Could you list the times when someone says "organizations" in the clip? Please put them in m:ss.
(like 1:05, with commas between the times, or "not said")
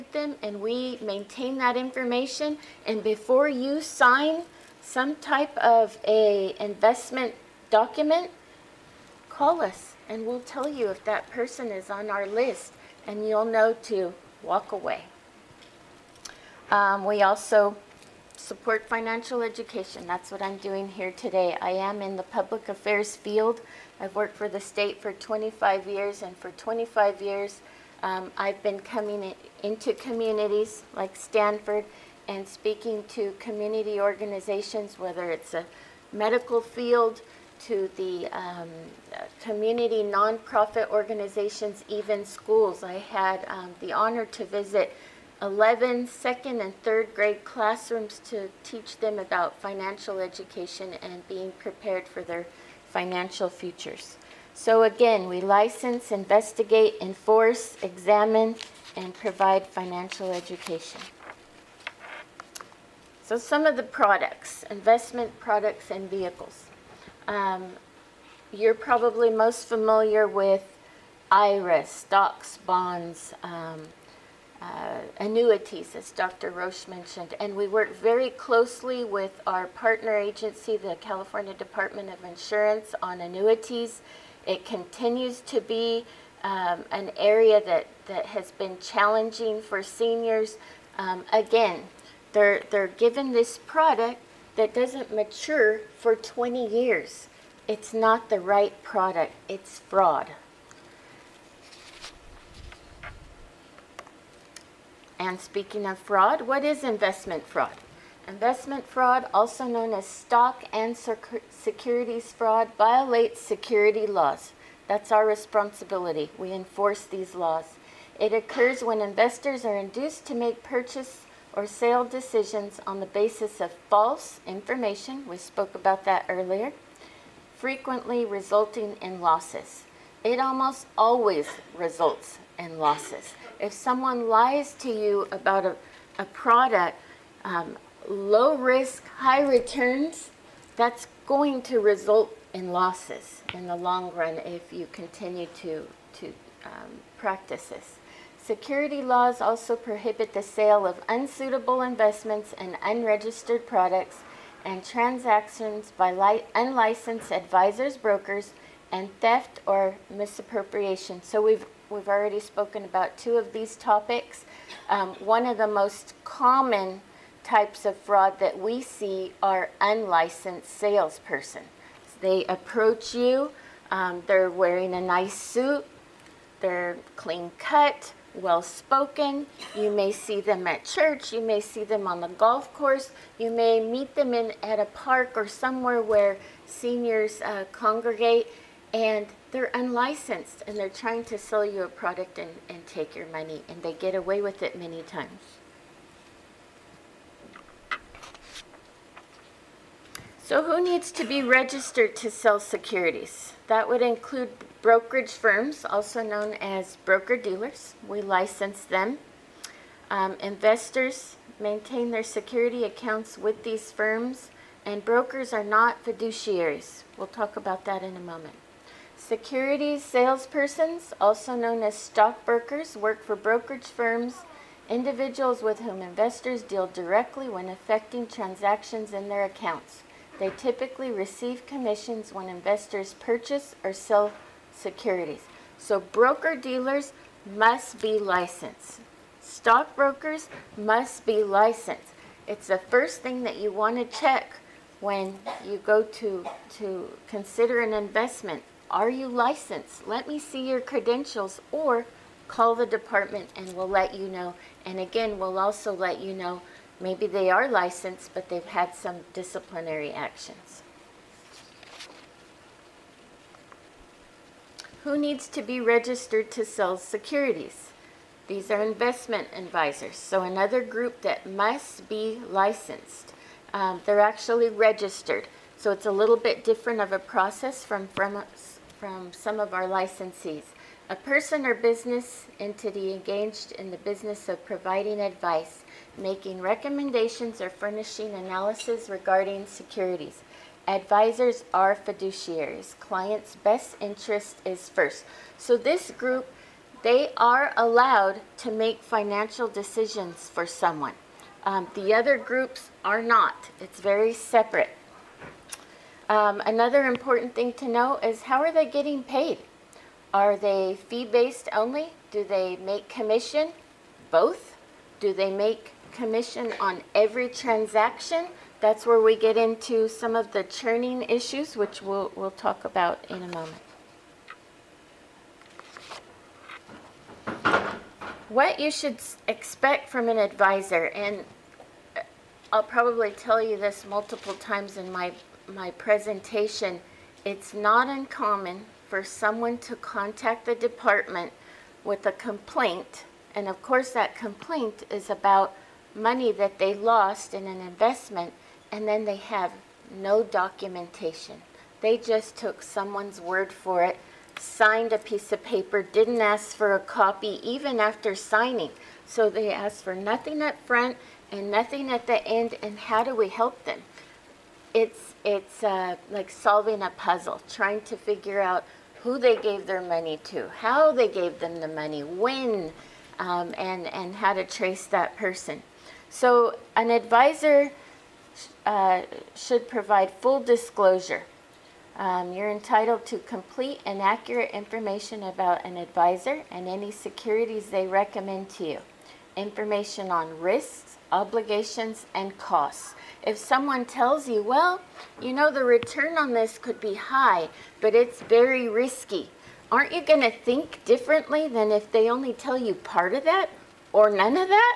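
0:33, 0:40.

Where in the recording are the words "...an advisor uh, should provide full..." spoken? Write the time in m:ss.
6:16.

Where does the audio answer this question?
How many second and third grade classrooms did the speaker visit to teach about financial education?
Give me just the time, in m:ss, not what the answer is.
0:45.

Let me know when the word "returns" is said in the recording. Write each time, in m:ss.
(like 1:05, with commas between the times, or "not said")
2:19, 6:35.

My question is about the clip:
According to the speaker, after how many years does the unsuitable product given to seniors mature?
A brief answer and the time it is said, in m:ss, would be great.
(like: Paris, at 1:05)
20 years, at 1:36.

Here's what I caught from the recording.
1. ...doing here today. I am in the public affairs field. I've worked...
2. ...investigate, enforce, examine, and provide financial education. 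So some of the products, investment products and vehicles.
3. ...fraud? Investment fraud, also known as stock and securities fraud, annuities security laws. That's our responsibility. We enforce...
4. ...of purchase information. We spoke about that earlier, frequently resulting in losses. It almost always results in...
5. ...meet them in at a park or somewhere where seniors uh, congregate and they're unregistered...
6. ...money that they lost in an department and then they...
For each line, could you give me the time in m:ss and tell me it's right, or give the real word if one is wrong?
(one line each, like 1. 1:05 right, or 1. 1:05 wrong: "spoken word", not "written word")
1. 0:20 right
2. 0:56 right
3. 1:47 wrong: "violates", not "annuities"
4. 2:03 wrong: "false", not "purchase"
5. 3:03 wrong: "unlicensed", not "unregistered"
6. 5:46 wrong: "investment", not "department".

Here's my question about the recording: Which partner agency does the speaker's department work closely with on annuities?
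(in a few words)
California Department of Insurance.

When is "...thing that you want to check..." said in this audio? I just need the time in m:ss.
4:03.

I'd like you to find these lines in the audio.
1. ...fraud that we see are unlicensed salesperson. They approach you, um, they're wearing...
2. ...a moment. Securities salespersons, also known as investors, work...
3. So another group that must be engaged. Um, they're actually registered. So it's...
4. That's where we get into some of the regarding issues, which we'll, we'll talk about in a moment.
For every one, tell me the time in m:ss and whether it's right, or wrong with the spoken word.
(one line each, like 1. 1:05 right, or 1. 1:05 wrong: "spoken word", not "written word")
1. 2:47 right
2. 3:38 wrong: "stockbrokers", not "investors"
3. 4:30 wrong: "licensed", not "engaged"
4. 5:18 wrong: "churning", not "regarding".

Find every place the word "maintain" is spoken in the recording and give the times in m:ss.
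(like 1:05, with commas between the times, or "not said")
0:01, 3:31.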